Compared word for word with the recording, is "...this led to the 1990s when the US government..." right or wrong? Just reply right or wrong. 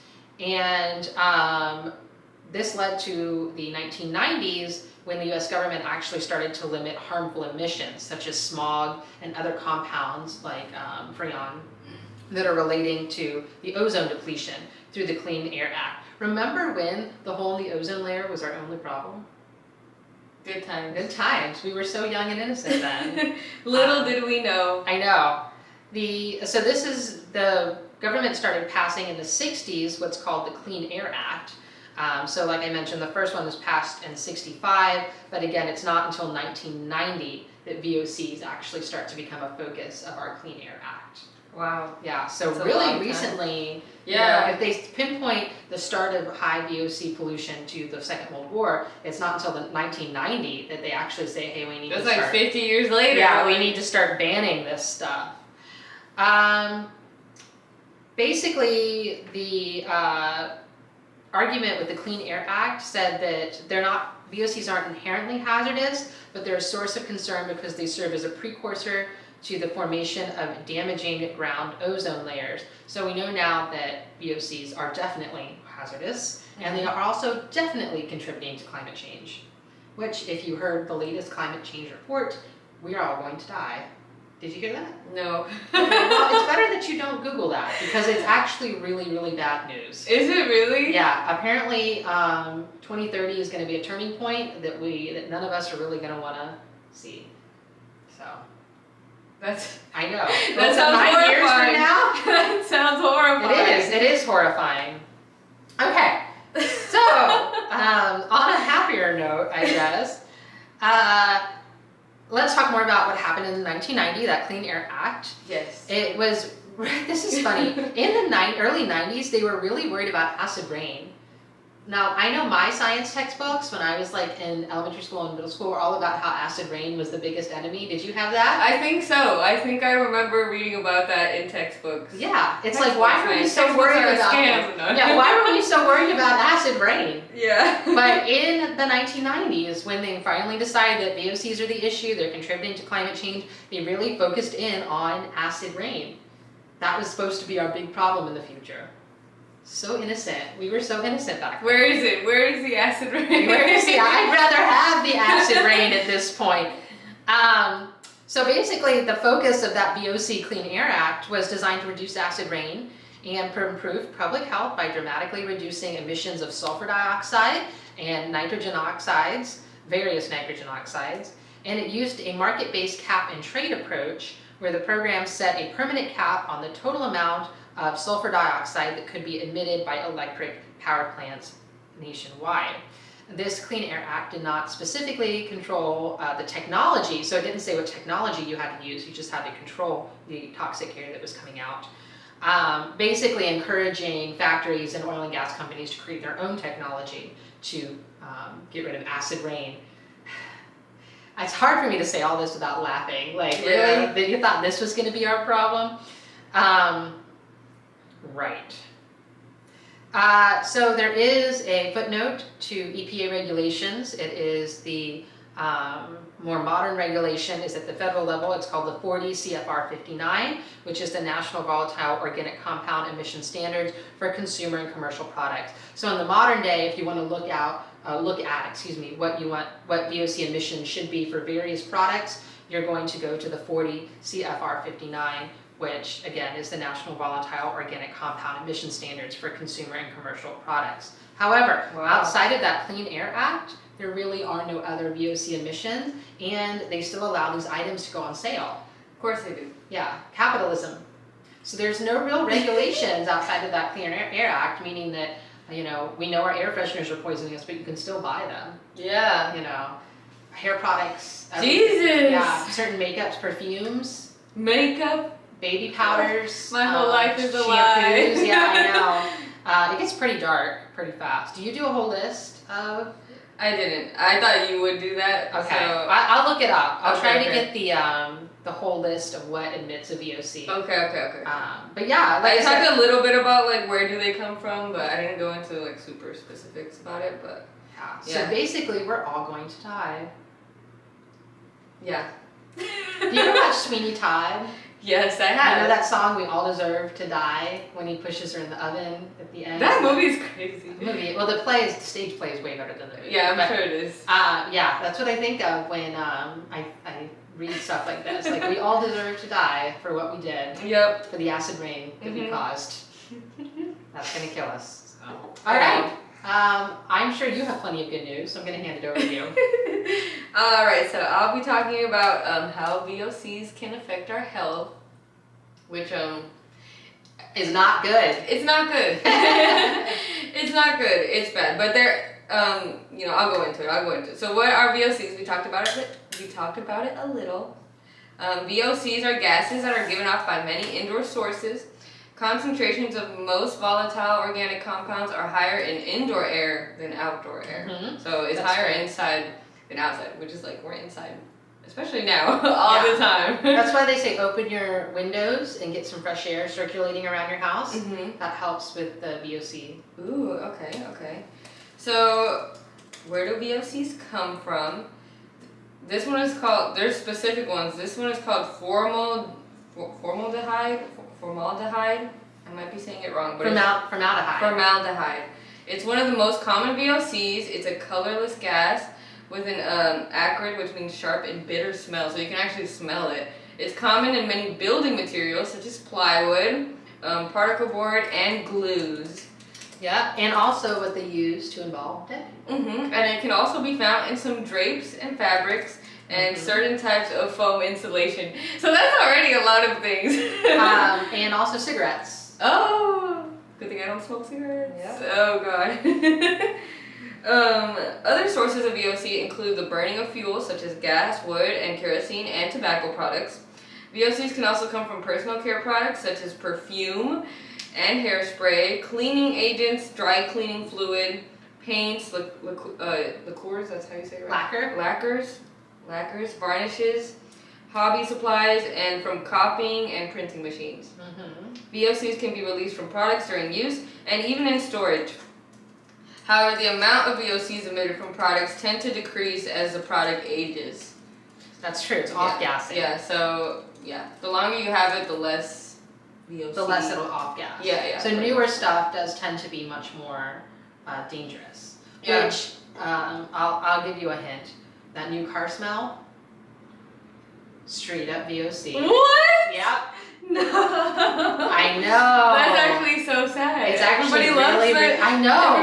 right.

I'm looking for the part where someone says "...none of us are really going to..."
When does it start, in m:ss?
1:35.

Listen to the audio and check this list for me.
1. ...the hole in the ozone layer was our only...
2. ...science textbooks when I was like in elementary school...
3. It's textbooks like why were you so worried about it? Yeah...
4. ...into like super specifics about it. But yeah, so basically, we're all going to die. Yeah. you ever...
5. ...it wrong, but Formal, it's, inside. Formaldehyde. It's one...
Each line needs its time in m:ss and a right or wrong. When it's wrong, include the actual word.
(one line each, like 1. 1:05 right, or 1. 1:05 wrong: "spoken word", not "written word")
1. 0:17 right
2. 2:02 right
3. 2:12 right
4. 4:45 right
5. 6:13 wrong: "formaldehyde", not "inside".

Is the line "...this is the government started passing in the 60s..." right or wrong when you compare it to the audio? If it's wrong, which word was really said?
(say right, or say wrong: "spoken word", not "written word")
right.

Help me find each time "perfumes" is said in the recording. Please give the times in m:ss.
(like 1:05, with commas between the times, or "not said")
4:23, 6:56.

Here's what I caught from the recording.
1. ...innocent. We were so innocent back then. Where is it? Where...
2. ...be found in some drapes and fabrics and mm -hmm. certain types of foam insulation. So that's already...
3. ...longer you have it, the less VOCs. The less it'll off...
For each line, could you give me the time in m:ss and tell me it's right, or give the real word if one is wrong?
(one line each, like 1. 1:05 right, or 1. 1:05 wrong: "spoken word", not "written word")
1. 2:30 right
2. 6:33 right
3. 7:24 right.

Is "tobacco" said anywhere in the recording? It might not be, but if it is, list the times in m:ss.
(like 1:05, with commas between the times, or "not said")
6:52.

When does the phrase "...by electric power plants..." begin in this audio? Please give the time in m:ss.
2:59.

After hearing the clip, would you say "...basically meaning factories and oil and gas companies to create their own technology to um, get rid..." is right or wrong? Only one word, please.
wrong.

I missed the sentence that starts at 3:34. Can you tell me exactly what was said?
It is the um, more modern regulation is at the federal level.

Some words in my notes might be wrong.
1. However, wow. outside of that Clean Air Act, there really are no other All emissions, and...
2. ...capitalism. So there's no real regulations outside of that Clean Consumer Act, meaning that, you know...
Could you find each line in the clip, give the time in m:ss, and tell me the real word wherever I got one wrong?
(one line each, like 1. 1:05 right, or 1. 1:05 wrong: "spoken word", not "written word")
1. 4:01 wrong: "VOC", not "All"
2. 4:10 wrong: "Air", not "Consumer".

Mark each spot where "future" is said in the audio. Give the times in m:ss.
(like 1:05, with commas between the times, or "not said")
2:28.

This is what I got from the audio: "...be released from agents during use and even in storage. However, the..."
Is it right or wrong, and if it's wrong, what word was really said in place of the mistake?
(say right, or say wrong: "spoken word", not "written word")
wrong: "products", not "agents".